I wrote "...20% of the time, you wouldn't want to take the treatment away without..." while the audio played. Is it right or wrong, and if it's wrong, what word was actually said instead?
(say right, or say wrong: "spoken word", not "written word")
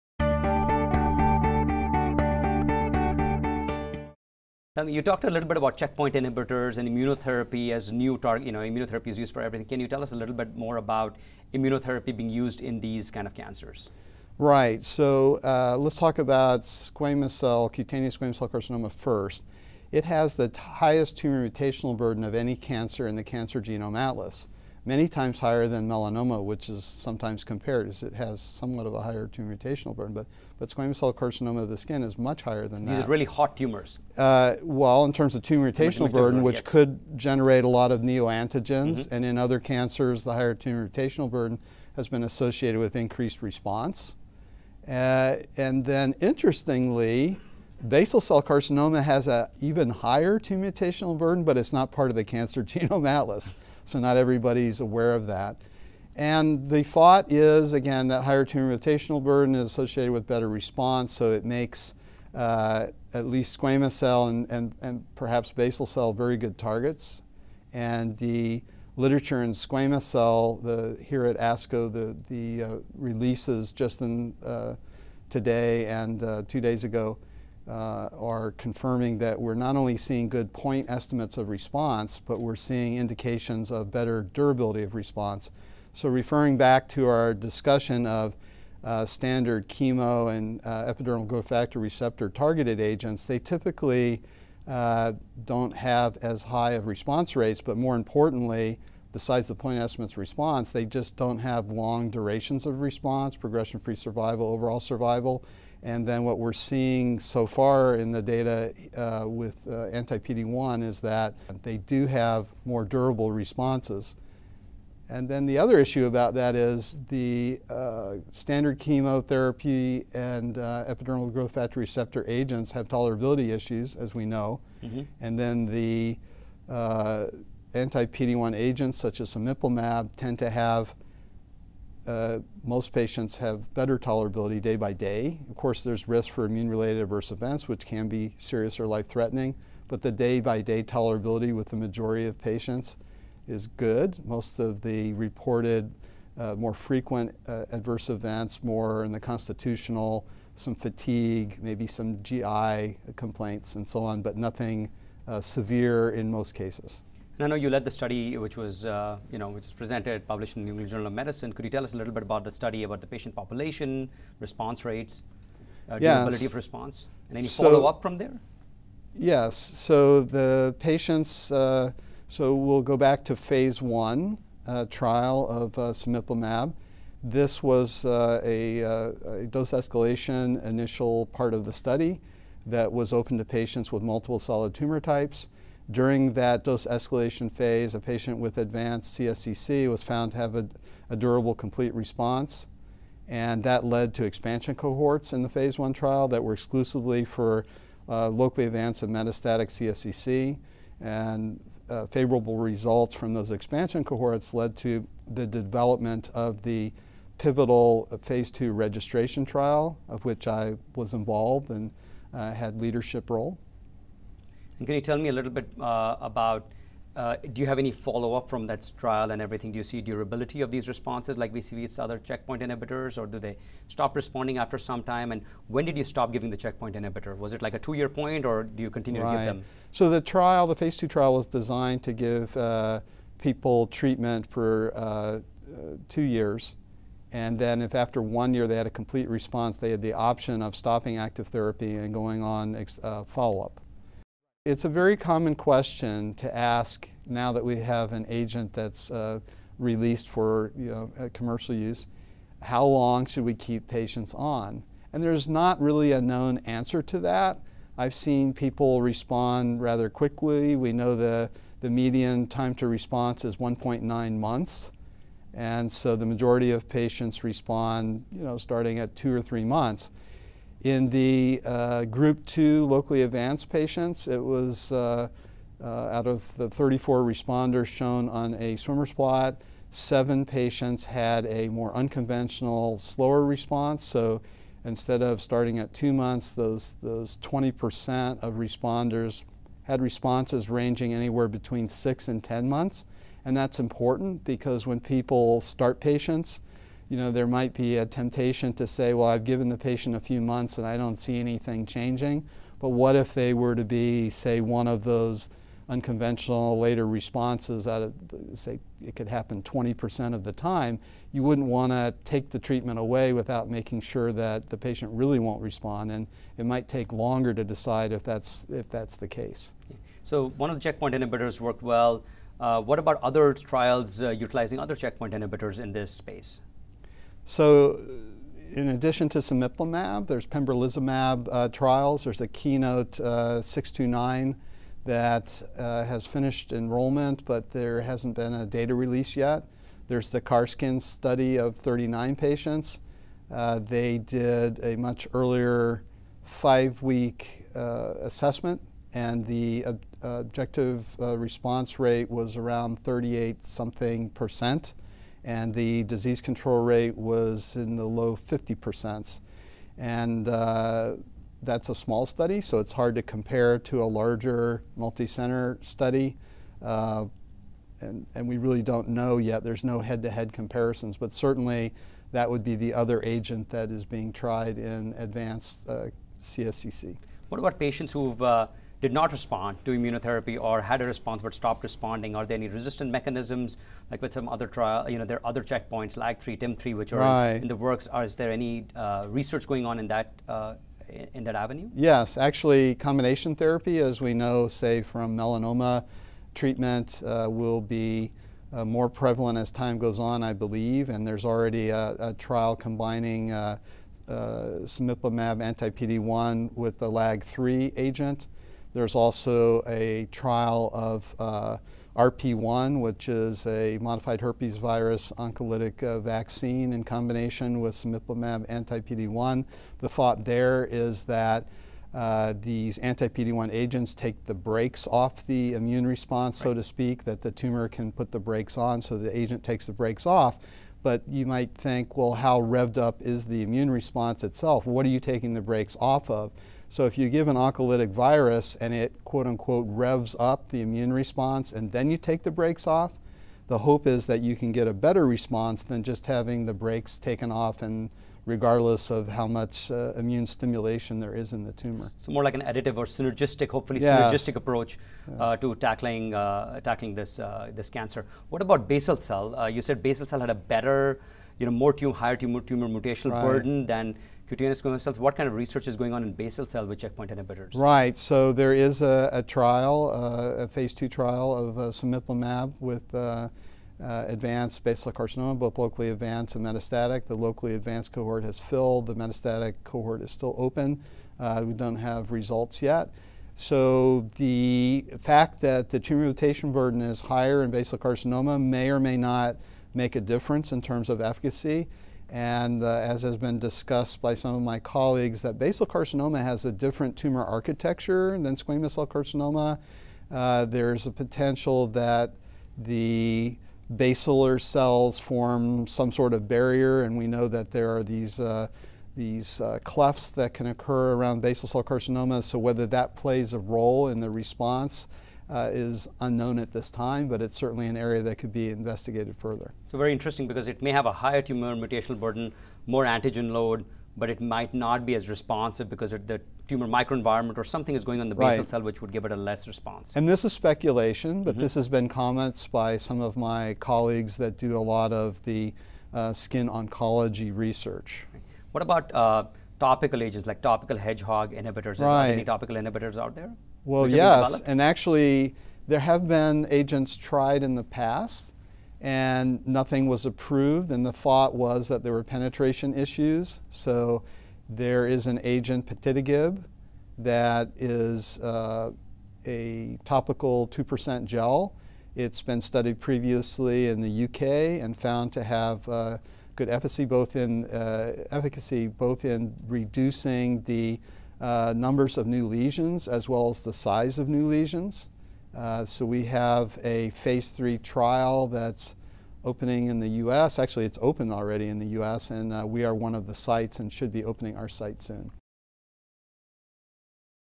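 right.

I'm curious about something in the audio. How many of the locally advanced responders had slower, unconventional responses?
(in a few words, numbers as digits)
7.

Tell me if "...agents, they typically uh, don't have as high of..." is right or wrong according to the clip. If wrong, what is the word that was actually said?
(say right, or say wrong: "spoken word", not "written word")
right.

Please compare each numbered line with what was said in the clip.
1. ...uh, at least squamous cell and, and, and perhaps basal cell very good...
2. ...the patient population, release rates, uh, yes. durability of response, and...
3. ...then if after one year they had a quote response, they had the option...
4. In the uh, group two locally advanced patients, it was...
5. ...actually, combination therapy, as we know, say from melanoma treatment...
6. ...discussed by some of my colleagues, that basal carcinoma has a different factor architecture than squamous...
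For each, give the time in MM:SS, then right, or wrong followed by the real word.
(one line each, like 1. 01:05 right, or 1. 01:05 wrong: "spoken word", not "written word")
1. 01:02 right
2. 02:43 wrong: "response", not "release"
3. 03:57 wrong: "complete", not "quote"
4. 04:30 right
5. 06:32 right
6. 08:13 wrong: "tumor", not "factor".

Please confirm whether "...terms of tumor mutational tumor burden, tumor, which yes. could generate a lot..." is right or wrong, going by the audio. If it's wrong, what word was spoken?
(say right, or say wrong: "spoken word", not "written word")
right.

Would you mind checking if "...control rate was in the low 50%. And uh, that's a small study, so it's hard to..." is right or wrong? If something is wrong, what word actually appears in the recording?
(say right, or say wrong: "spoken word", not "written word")
right.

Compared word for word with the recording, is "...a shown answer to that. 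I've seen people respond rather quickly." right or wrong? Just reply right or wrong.
wrong.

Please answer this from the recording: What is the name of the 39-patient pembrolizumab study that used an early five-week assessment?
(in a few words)
CARSKIN.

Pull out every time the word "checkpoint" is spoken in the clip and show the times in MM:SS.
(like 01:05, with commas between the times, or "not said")
00:05, 03:42, 03:46, 05:20, 05:24, 06:25, 07:46.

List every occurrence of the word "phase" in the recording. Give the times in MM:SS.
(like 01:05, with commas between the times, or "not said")
02:53, 03:07, 03:15, 03:28, 03:50, 07:50, 09:37.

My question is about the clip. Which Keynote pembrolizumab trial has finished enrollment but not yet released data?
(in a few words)
Keynote 629.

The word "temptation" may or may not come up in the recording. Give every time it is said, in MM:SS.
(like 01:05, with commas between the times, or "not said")
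04:58.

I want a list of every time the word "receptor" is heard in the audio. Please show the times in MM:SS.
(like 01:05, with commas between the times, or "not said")
01:31, 02:01.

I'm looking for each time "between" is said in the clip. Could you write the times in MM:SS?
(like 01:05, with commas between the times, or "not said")
04:51.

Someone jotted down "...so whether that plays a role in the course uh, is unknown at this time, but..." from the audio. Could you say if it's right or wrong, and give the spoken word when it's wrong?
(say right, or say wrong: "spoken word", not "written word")
wrong: "response", not "course".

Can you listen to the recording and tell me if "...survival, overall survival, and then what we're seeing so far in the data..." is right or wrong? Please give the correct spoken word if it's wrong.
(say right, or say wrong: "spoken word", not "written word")
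right.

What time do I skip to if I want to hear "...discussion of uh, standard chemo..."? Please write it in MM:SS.
01:27.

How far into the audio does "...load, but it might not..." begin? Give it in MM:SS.
08:43.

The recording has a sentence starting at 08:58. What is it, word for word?
What about uh, topical agents like topical hedgehog inhibitors?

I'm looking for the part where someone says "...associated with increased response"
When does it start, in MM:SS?
00:42.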